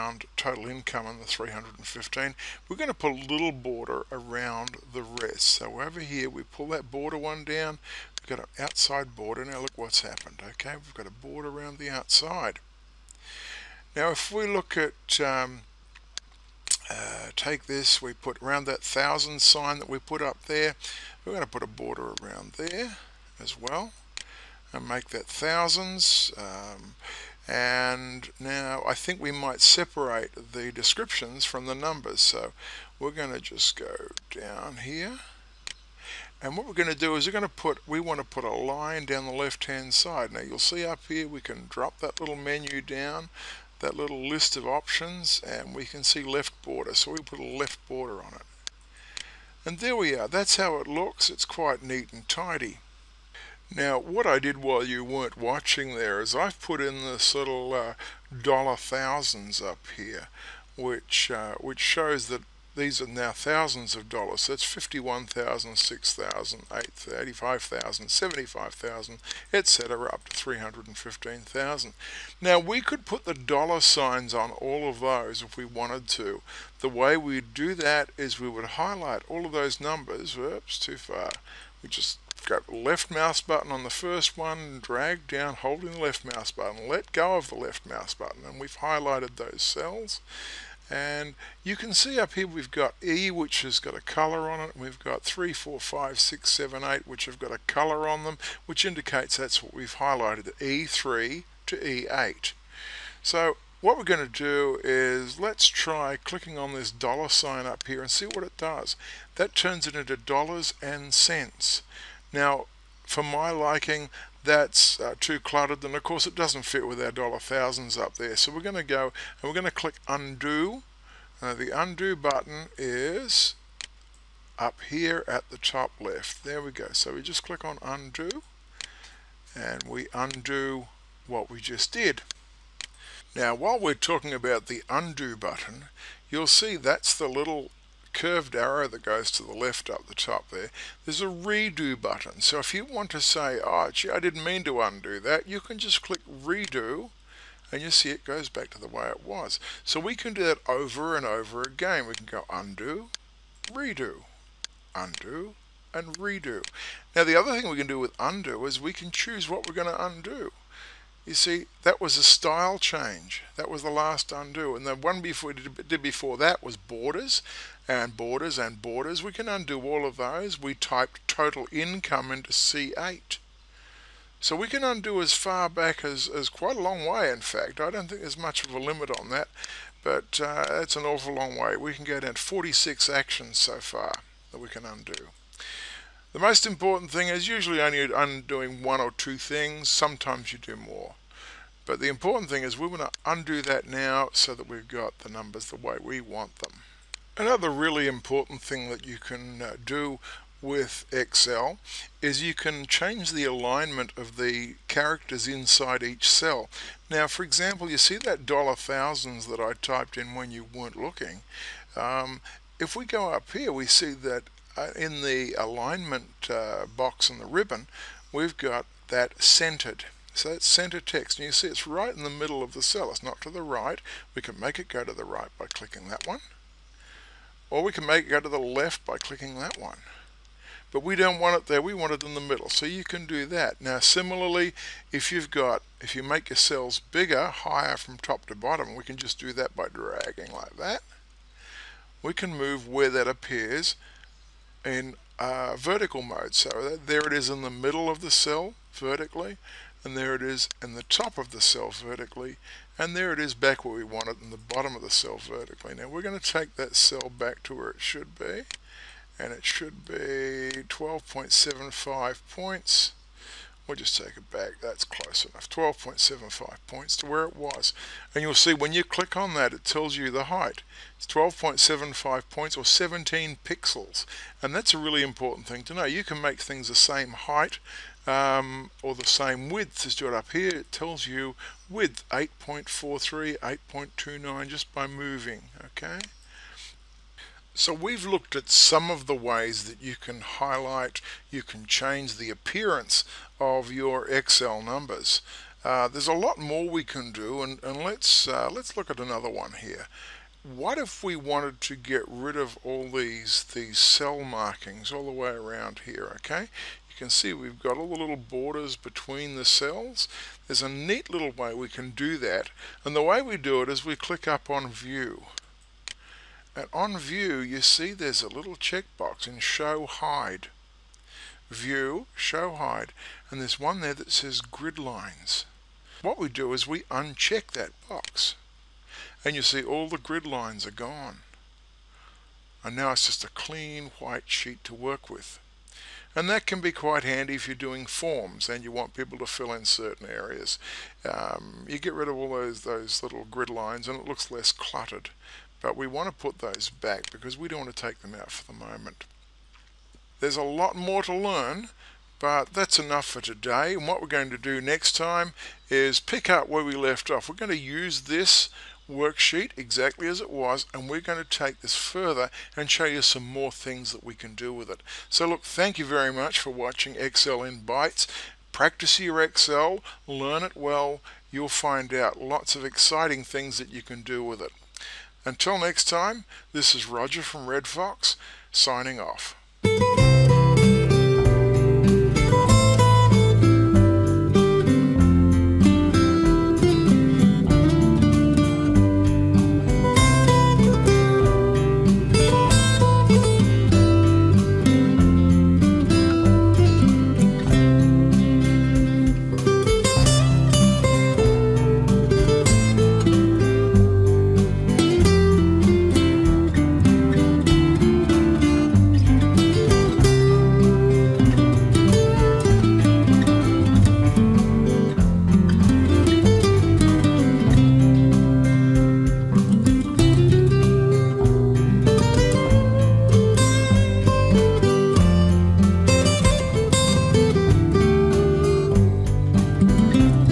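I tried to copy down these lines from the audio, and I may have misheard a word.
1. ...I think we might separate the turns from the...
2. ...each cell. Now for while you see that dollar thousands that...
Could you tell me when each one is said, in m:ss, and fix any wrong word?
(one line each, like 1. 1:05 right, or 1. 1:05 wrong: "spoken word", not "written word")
1. 0:28 wrong: "descriptions", not "turns"
2. 3:26 wrong: "example", not "while".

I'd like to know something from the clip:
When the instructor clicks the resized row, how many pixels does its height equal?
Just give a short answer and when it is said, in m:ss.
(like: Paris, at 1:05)
17 pixels, at 4:32.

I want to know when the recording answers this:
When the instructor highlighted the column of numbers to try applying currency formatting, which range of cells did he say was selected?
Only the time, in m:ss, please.
1:40.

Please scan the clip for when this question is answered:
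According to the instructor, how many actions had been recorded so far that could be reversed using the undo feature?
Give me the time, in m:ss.
3:02.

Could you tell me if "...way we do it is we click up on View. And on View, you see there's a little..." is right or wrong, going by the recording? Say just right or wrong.
right.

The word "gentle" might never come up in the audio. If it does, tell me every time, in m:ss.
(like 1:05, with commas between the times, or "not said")
not said.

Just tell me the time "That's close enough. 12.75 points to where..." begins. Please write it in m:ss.
4:24.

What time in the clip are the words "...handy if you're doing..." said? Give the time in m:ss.
5:37.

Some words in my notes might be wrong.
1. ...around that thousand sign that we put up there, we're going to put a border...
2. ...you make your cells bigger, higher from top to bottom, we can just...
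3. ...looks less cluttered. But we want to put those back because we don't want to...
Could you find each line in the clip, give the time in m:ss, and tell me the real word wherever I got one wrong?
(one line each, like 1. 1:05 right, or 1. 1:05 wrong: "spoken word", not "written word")
1. 0:18 right
2. 3:56 right
3. 5:44 right.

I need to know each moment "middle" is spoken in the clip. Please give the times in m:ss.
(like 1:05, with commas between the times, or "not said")
3:42, 3:52, 4:07.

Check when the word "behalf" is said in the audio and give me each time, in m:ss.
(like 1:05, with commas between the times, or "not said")
not said.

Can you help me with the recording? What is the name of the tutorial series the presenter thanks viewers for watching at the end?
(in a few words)
Excel in Bites.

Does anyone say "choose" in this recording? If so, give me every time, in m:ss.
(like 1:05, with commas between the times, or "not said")
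2:39.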